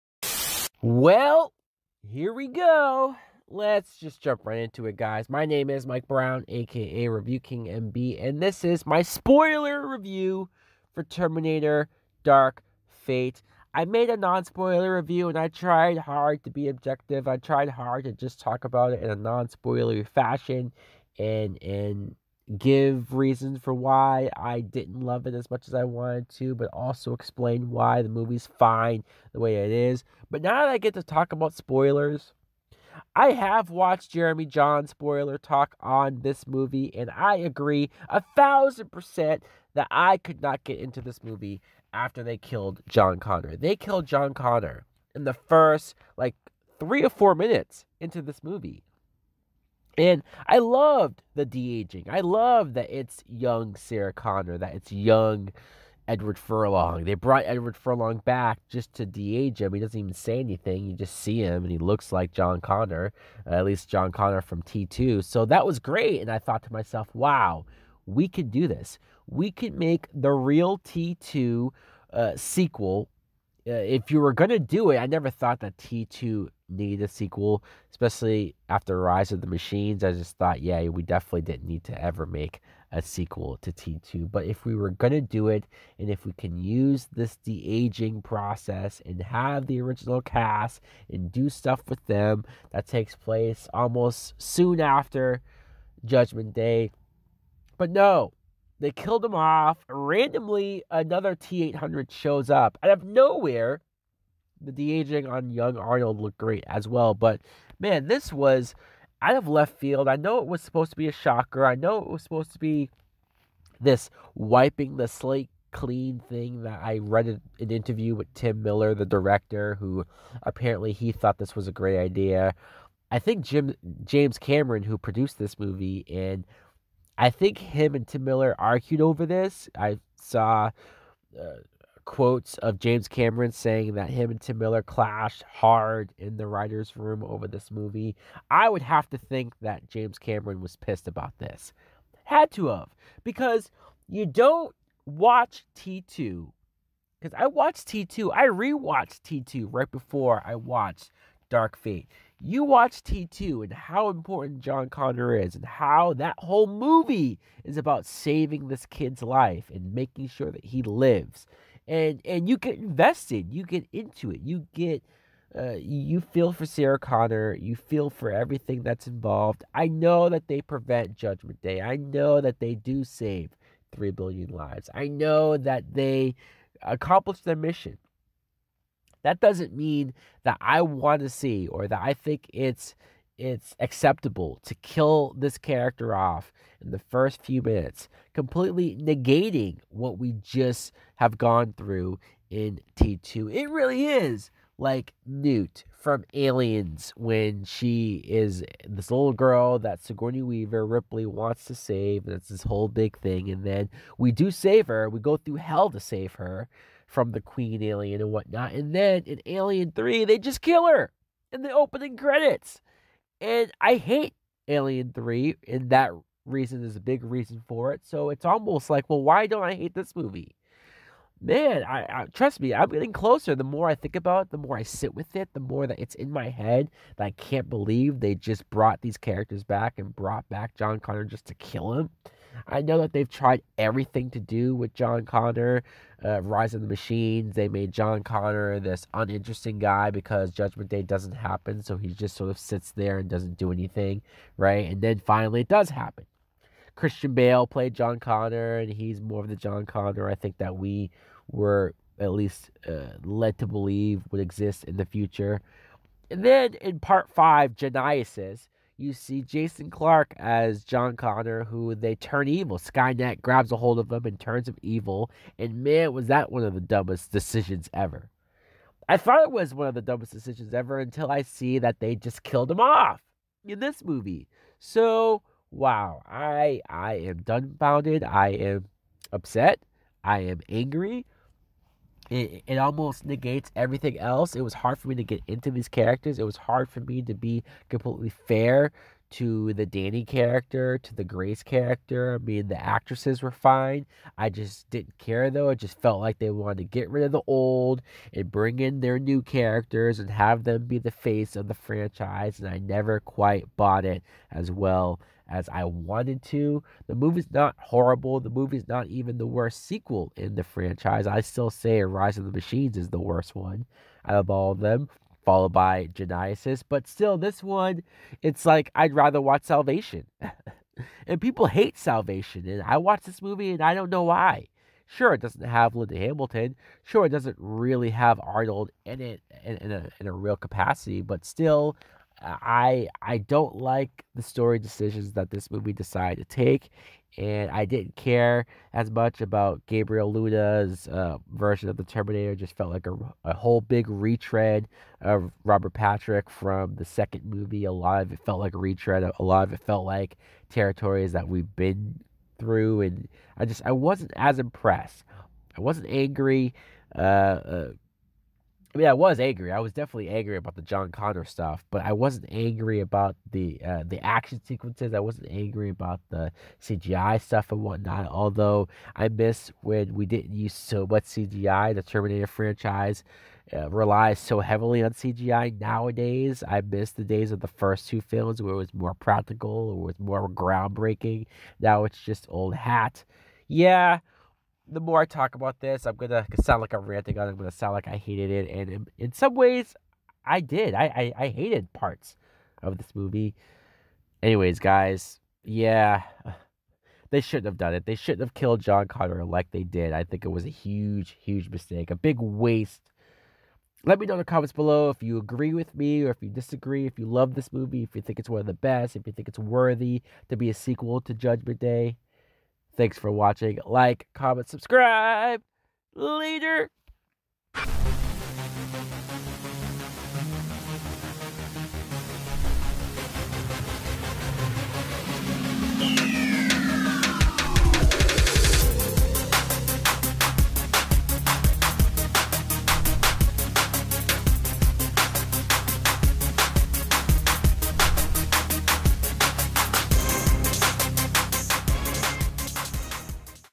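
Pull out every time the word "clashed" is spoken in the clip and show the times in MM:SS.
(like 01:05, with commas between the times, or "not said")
02:14.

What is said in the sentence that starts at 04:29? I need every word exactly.
I thought it was one of the dumbest decisions ever until I see that they just killed him off in this movie.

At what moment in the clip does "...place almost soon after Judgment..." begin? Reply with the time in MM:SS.
01:33.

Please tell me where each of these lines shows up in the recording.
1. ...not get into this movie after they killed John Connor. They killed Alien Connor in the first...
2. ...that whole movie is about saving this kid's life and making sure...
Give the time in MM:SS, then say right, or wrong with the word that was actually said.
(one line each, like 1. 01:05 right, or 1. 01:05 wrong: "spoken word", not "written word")
1. 00:40 wrong: "John", not "Alien"
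2. 02:36 right.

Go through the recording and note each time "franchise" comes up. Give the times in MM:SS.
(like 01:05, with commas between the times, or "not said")
05:01, 05:10, 06:12.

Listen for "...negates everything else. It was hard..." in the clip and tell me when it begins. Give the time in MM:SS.
04:43.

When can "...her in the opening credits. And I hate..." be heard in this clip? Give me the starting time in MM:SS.
03:30.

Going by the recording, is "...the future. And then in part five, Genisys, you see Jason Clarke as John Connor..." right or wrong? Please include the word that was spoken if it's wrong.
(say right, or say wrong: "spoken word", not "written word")
right.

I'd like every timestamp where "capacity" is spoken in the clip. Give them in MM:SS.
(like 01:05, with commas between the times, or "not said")
05:30.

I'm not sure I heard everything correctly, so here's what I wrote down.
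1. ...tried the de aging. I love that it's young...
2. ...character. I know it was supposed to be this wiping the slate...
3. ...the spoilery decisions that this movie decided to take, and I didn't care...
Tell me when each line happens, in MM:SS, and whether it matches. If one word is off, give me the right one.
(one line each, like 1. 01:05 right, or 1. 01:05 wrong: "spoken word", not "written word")
1. 00:50 wrong: "loved", not "tried"
2. 01:51 wrong: "shocker", not "character"
3. 05:34 wrong: "story", not "spoilery".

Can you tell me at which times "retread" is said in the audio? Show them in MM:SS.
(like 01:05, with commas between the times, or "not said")
05:44, 05:48.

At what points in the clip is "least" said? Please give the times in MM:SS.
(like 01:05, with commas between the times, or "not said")
01:03, 04:12.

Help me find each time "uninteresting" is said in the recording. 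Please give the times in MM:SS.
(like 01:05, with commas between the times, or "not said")
03:59.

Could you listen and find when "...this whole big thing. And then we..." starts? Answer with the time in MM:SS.
03:22.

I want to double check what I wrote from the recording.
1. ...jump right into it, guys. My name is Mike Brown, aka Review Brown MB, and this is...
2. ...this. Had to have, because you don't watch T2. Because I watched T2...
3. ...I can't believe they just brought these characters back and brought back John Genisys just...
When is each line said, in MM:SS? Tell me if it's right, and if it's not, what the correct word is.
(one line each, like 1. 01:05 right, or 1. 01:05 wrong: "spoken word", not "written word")
1. 00:04 wrong: "King", not "Brown"
2. 02:21 right
3. 03:47 wrong: "Connor", not "Genisys".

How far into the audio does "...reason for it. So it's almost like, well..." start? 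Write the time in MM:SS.
03:37.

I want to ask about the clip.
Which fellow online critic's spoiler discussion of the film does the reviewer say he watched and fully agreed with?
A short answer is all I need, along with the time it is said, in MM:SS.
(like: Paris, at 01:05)
Jeremy Jahns, at 00:34.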